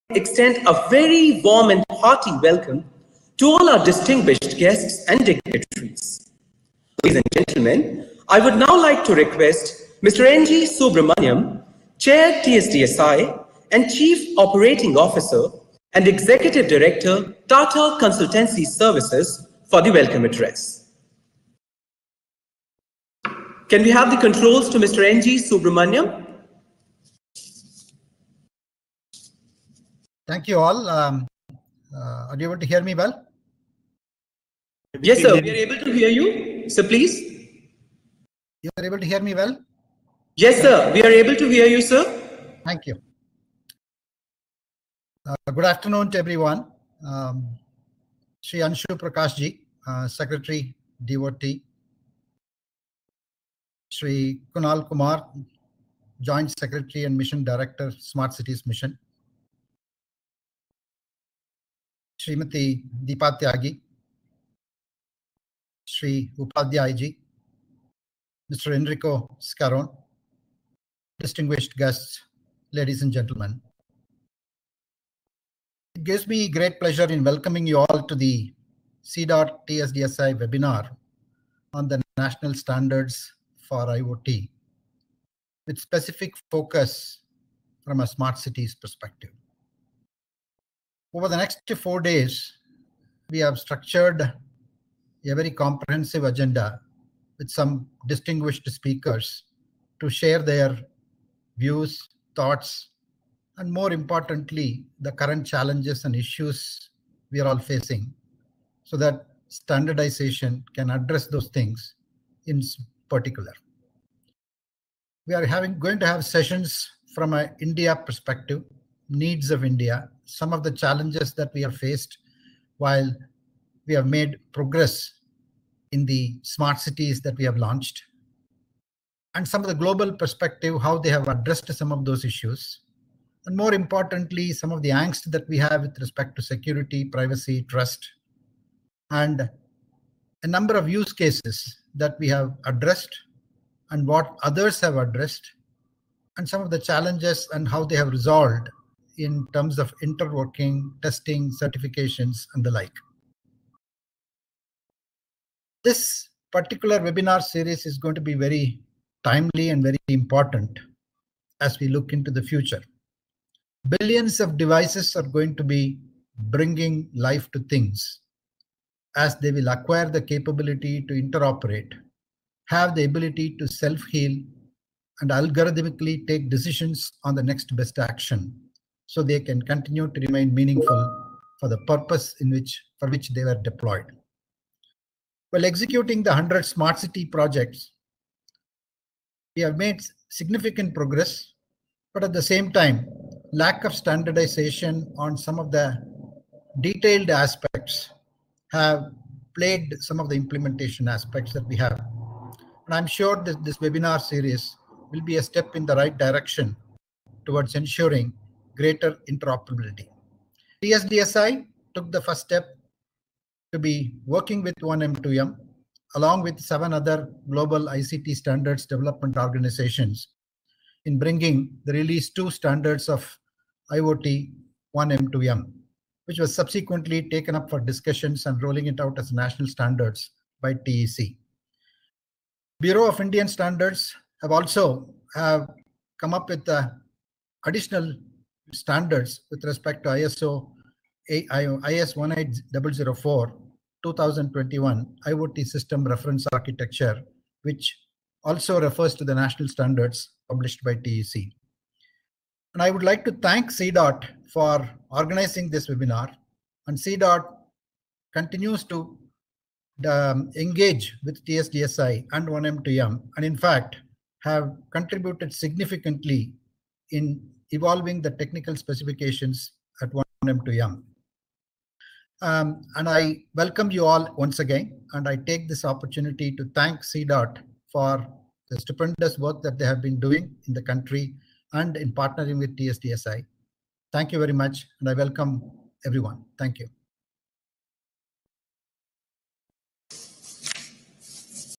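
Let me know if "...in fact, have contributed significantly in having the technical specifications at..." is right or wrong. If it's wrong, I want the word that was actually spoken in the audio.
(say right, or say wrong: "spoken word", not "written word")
wrong: "evolving", not "having".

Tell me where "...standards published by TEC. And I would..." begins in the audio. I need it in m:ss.
4:09.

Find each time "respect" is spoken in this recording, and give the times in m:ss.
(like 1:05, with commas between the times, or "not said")
2:15, 3:59.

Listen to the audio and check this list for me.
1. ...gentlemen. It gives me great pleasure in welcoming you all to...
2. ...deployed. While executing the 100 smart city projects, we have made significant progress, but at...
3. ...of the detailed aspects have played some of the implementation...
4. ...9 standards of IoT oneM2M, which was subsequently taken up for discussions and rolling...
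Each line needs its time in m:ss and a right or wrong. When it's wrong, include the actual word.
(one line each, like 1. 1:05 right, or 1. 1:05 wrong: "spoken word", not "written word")
1. 1:13 right
2. 3:03 right
3. 3:15 right
4. 3:42 wrong: "2", not "9".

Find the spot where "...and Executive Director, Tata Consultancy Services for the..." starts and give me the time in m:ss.
0:15.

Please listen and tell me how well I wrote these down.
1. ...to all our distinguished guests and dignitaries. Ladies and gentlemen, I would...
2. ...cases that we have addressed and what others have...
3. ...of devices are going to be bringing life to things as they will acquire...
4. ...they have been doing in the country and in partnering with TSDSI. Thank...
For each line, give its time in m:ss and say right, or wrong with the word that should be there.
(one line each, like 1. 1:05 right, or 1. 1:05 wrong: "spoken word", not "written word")
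1. 0:03 right
2. 2:21 right
3. 2:44 right
4. 4:39 right.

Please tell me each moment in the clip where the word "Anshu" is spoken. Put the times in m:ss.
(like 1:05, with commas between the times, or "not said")
0:48.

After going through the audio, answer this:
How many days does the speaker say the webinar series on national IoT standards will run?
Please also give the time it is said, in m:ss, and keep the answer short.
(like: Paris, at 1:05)
4, at 1:31.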